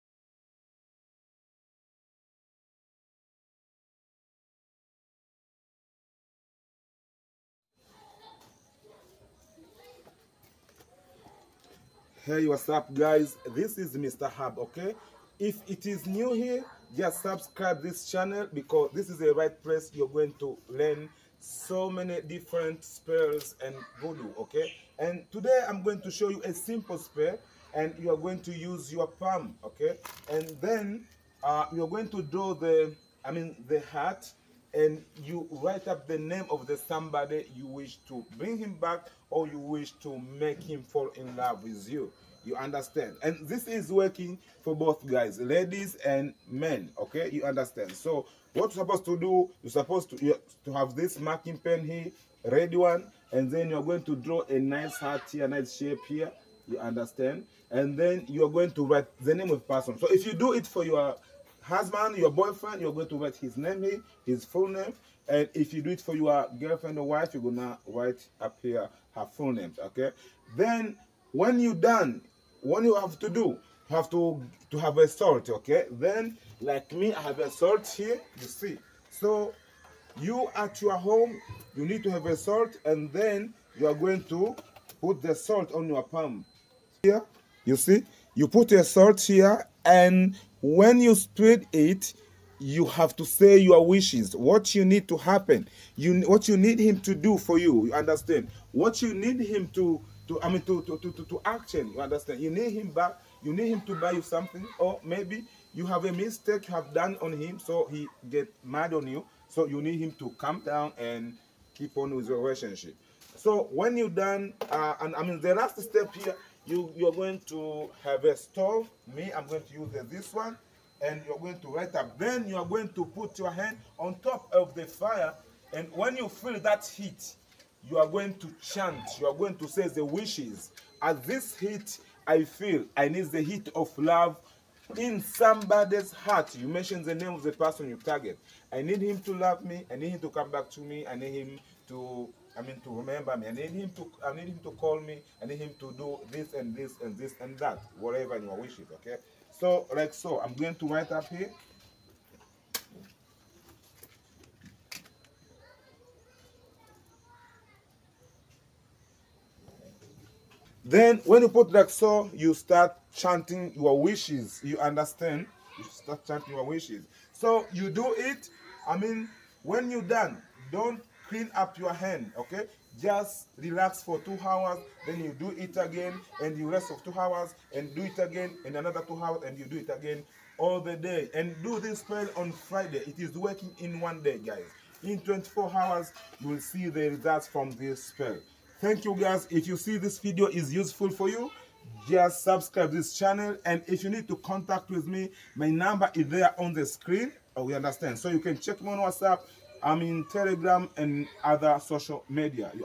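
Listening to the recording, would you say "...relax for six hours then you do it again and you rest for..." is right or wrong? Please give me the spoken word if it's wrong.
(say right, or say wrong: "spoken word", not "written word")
wrong: "two", not "six".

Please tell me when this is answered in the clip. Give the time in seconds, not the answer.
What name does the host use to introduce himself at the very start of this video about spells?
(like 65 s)
13 s.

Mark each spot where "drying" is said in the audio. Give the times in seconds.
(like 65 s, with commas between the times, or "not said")
not said.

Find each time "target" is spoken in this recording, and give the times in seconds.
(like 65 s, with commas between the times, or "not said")
138 s.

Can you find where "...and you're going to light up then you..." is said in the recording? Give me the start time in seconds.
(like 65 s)
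121 s.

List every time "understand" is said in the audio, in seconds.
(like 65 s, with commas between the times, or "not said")
42 s, 47 s, 56 s, 97 s, 102 s, 164 s, 197 s.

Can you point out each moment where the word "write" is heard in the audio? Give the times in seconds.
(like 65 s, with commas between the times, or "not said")
35 s, 58 s, 63 s, 67 s, 150 s.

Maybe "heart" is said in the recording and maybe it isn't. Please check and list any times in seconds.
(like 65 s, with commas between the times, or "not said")
33 s, 54 s, 136 s.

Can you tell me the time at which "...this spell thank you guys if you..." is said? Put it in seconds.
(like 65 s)
187 s.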